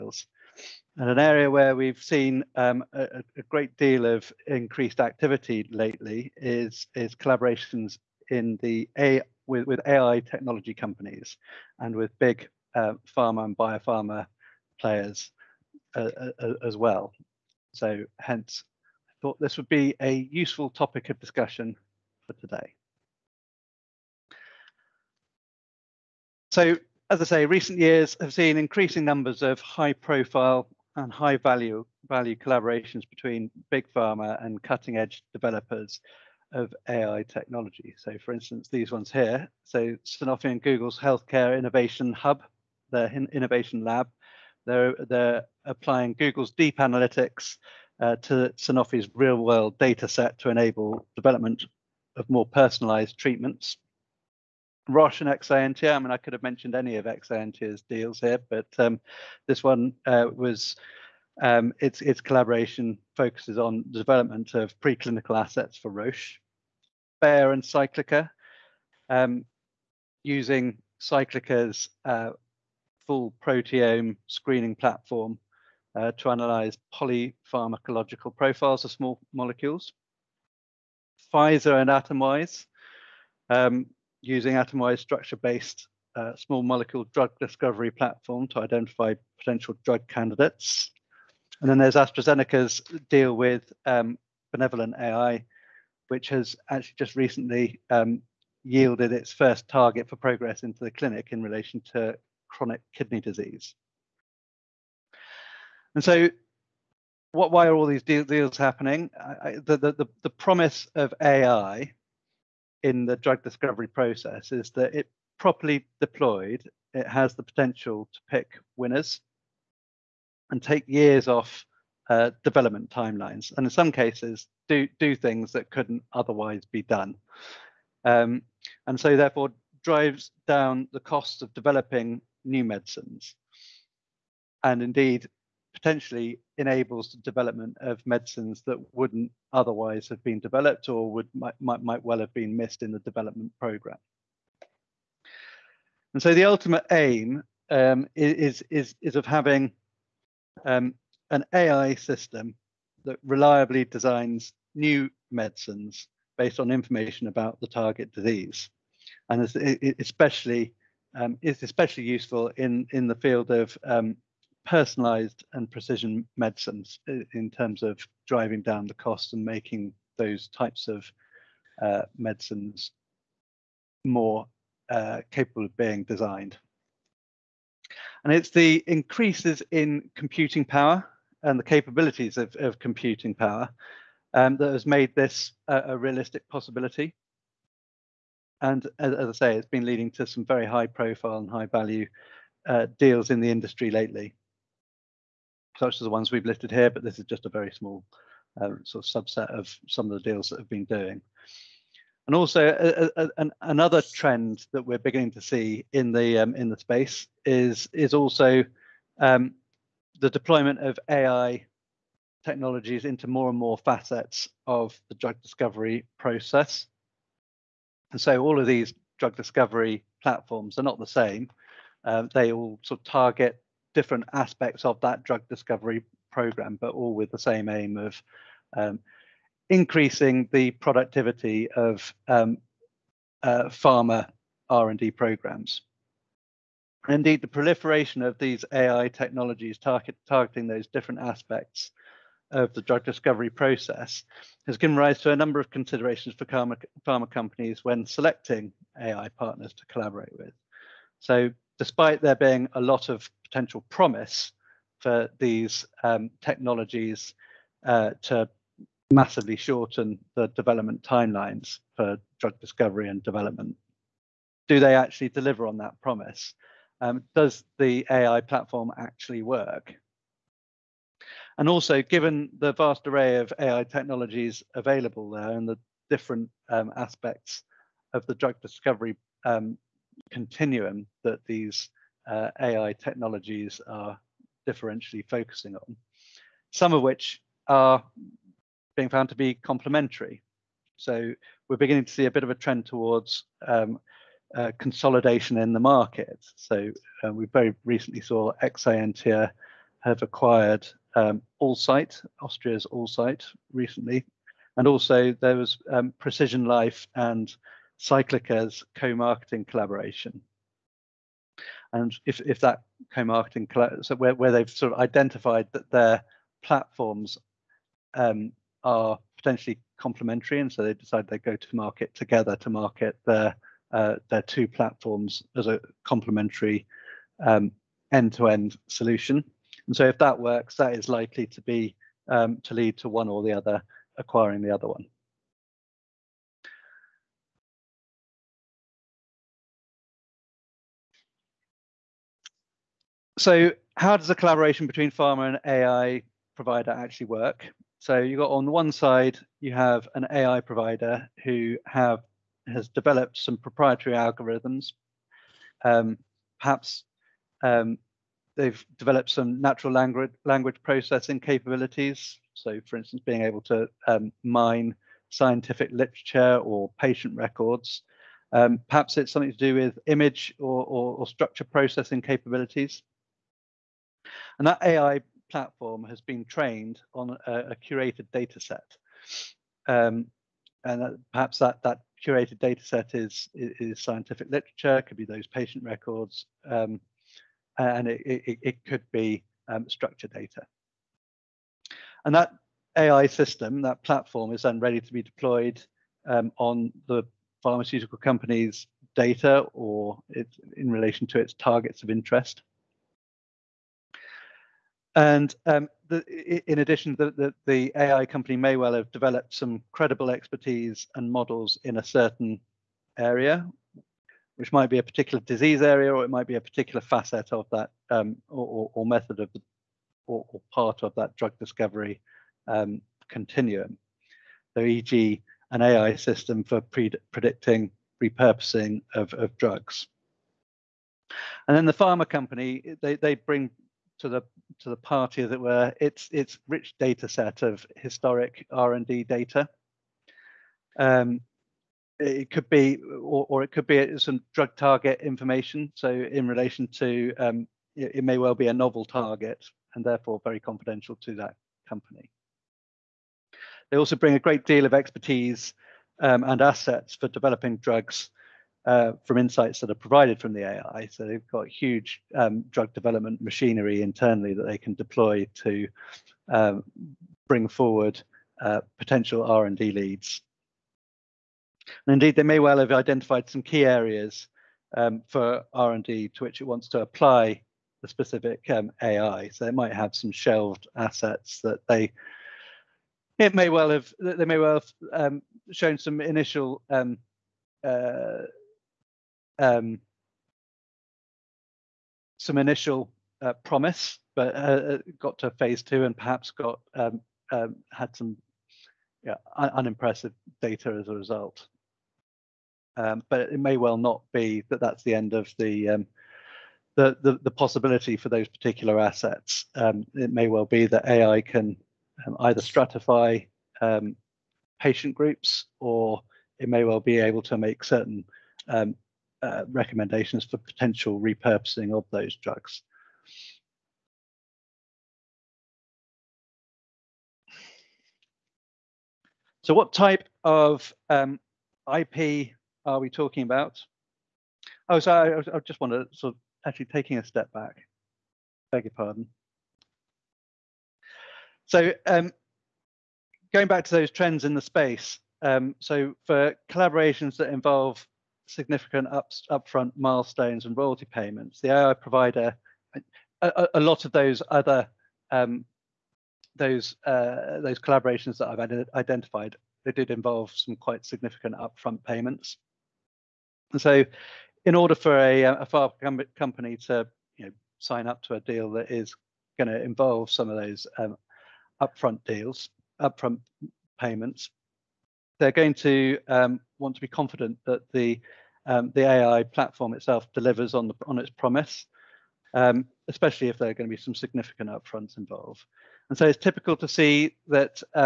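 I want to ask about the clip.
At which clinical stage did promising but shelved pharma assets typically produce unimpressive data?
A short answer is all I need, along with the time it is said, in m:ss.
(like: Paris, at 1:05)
phase two, at 8:15.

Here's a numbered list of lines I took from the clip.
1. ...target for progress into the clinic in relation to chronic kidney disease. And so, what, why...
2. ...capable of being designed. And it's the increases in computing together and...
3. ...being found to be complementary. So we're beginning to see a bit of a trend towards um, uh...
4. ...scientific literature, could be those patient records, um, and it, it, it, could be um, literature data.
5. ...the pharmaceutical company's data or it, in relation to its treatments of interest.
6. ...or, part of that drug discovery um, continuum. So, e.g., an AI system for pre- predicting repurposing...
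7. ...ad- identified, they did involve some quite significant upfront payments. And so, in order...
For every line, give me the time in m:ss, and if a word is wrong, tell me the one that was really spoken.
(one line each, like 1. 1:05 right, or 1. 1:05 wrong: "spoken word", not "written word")
1. 1:39 right
2. 2:55 wrong: "power", not "together"
3. 4:48 right
4. 6:24 wrong: "structure", not "literature"
5. 6:37 wrong: "targets", not "treatments"
6. 7:00 right
7. 9:18 right.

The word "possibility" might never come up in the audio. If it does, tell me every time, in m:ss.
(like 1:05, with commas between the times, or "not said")
3:06, 8:27.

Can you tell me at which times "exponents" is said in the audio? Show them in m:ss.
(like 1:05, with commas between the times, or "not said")
not said.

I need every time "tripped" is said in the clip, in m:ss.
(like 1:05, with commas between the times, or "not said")
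not said.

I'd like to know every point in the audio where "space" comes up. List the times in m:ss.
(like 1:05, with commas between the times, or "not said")
3:26, 9:04.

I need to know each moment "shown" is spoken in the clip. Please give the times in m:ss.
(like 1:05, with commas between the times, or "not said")
8:05.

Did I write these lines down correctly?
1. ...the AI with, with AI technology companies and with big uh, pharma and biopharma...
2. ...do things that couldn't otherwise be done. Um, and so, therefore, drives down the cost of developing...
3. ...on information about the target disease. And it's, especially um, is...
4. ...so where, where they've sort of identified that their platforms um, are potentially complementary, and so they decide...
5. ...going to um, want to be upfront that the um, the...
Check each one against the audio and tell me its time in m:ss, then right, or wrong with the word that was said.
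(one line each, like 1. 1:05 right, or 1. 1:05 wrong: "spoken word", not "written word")
1. 0:08 right
2. 2:04 right
3. 2:36 right
4. 5:14 right
5. 9:35 wrong: "confident", not "upfront".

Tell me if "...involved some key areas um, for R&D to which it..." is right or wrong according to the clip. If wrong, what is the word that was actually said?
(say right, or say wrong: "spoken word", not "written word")
wrong: "identified", not "involved".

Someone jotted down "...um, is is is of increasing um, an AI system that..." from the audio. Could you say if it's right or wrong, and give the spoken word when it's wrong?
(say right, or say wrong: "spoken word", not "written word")
wrong: "having", not "increasing".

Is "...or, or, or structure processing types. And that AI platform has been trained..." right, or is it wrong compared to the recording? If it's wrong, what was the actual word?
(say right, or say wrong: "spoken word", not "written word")
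wrong: "capabilities", not "types".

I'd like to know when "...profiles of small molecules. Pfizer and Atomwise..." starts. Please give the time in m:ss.
1:18.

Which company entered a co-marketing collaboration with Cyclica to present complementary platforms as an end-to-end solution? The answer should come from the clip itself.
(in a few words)
Precision Life.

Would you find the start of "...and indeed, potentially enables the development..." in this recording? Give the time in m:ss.
2:14.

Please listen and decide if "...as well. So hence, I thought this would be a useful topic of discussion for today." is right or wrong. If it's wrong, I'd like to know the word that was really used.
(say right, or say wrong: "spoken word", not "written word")
right.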